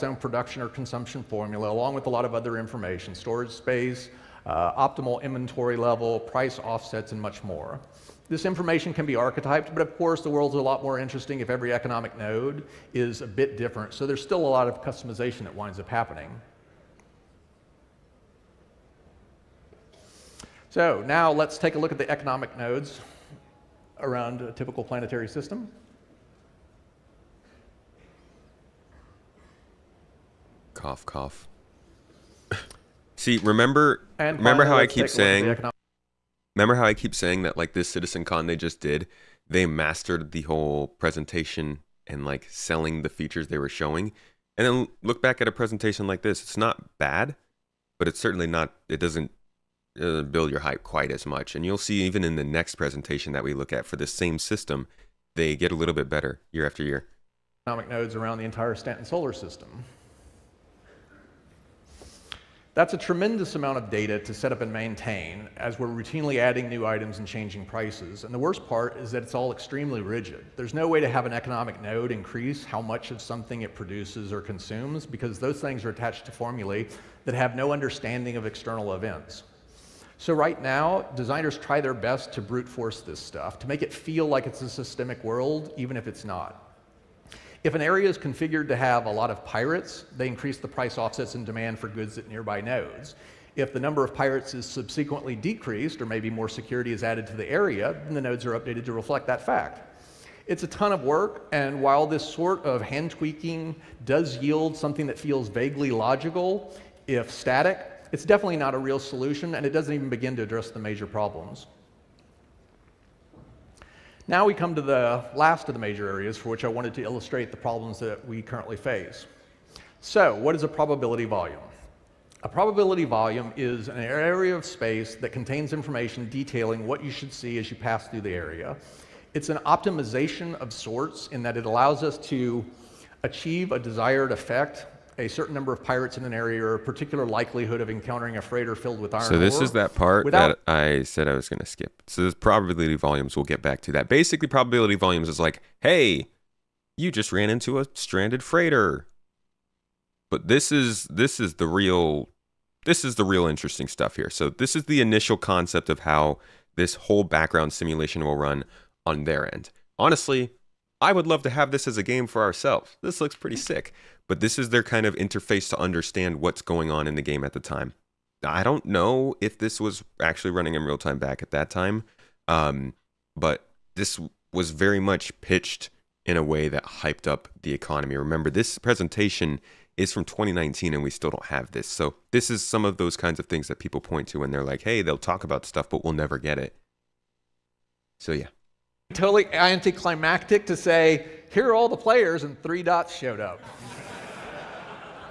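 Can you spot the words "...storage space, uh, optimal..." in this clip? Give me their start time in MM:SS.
00:03.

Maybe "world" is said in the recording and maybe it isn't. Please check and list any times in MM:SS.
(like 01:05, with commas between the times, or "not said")
00:10, 01:25.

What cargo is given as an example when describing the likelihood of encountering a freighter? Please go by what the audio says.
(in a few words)
Iron.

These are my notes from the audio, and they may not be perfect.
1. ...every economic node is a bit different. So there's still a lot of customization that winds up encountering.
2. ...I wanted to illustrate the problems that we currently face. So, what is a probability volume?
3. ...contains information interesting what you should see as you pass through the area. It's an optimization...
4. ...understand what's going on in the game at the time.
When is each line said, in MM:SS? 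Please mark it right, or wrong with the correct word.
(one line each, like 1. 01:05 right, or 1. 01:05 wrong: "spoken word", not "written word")
1. 00:11 wrong: "happening", not "encountering"
2. 01:56 right
3. 02:05 wrong: "detailing", not "interesting"
4. 02:45 right.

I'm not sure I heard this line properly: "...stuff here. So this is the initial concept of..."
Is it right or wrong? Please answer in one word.
right.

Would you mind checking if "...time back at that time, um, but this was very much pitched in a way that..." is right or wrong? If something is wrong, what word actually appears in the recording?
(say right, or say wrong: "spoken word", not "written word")
right.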